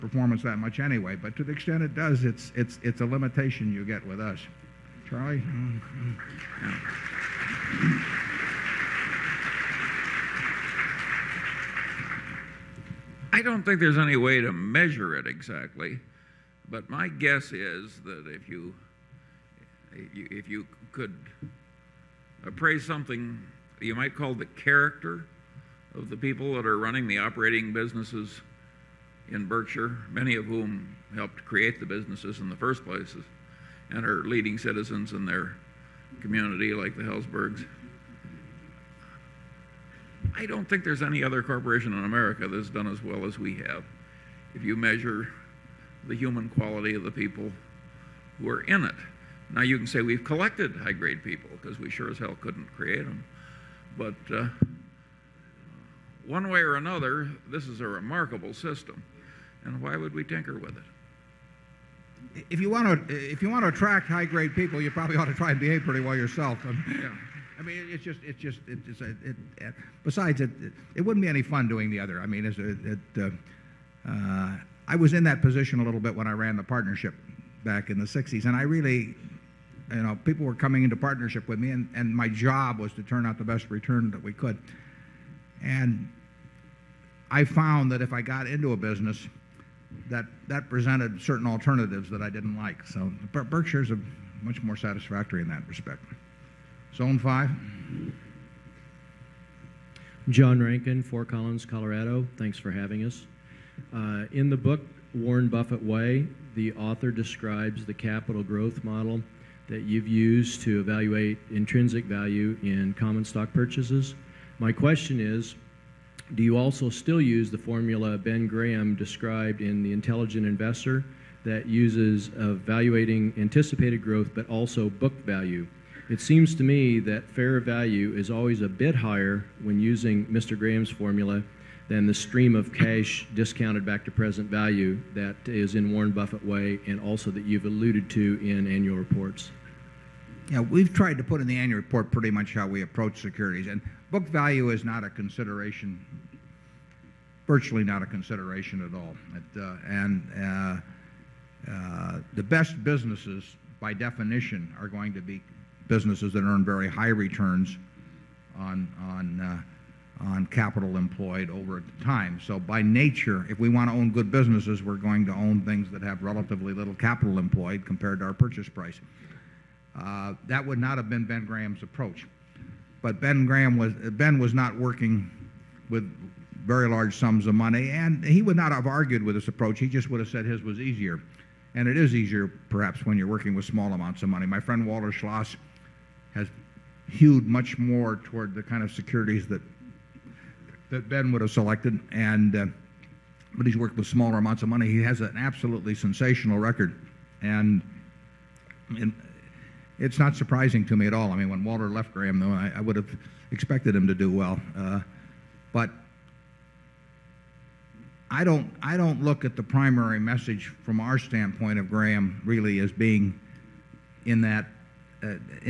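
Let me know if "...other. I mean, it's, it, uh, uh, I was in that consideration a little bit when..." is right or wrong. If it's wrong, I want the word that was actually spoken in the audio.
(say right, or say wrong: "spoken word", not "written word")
wrong: "position", not "consideration".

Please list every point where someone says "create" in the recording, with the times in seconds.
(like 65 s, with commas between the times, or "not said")
31 s, 52 s.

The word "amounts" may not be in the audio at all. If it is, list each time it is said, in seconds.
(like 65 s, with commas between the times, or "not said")
183 s, 194 s.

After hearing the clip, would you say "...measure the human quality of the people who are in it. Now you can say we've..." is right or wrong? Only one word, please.
right.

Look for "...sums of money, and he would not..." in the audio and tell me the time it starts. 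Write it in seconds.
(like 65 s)
177 s.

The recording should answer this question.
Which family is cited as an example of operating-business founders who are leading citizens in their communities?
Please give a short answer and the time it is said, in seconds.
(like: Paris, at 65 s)
Helzbergs, at 37 s.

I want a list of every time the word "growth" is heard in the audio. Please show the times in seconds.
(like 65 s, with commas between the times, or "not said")
108 s, 124 s.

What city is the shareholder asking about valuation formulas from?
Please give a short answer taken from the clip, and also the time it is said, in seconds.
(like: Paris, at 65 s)
Fort Collins, Colorado, at 101 s.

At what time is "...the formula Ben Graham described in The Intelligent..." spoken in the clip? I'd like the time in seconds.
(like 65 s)
117 s.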